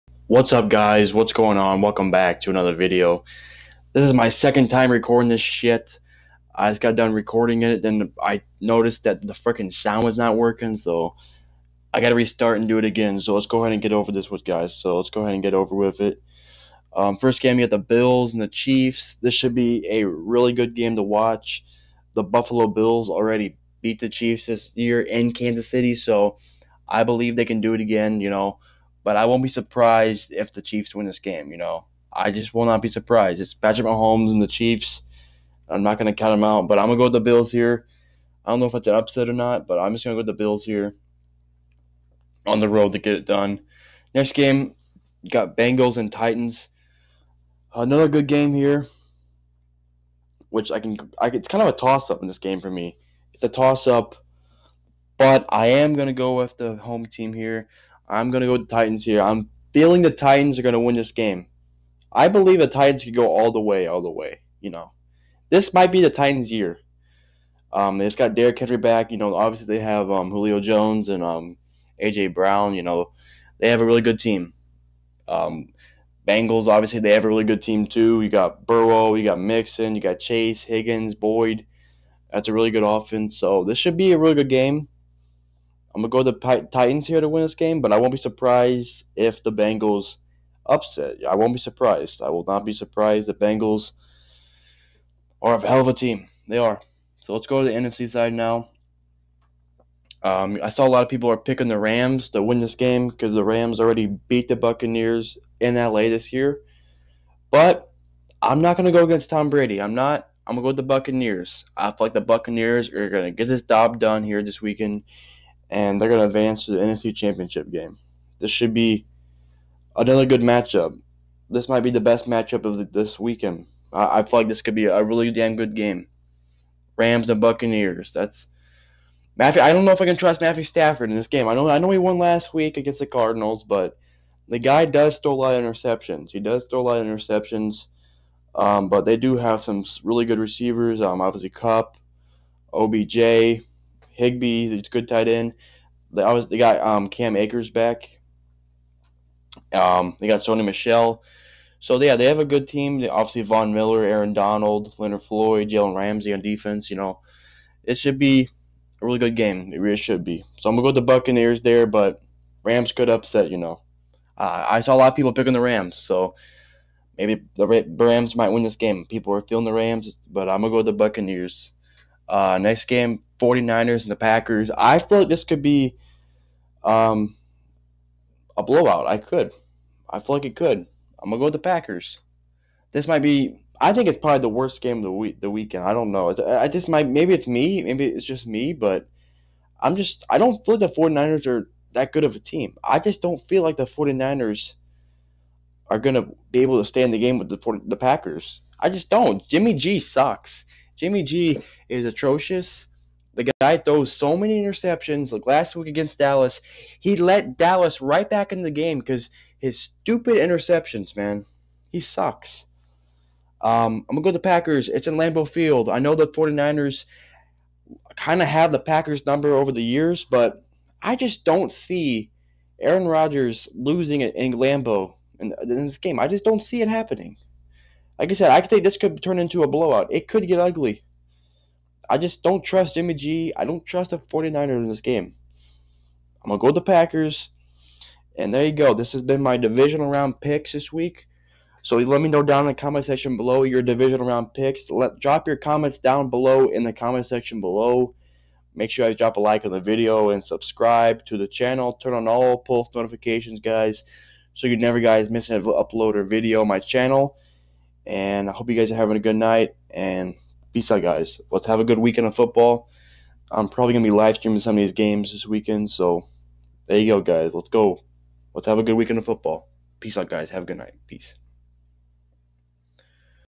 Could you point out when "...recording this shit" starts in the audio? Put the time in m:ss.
0:04.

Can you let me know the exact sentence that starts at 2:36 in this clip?
You know, it should be a really good game.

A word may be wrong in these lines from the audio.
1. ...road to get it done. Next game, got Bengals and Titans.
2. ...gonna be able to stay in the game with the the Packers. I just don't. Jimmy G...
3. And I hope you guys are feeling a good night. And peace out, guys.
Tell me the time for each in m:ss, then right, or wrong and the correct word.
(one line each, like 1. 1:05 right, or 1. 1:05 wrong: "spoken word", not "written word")
1. 0:42 right
2. 3:15 right
3. 4:18 wrong: "having", not "feeling".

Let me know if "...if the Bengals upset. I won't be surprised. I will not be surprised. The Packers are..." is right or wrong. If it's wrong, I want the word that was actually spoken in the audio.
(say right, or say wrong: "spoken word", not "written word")
wrong: "Bengals", not "Packers".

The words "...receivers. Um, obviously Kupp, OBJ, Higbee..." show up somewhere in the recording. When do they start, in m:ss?
2:20.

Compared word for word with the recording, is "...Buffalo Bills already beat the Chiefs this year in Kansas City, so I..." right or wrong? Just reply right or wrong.
right.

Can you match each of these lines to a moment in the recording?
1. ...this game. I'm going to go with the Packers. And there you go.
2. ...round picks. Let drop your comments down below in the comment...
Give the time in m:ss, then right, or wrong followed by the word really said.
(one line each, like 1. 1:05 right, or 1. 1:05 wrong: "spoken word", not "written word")
1. 3:54 right
2. 4:04 right.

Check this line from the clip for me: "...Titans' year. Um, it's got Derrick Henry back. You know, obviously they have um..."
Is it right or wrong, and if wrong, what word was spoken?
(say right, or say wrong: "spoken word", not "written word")
right.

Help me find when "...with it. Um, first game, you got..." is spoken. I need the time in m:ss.
0:15.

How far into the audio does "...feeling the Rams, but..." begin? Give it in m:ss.
2:49.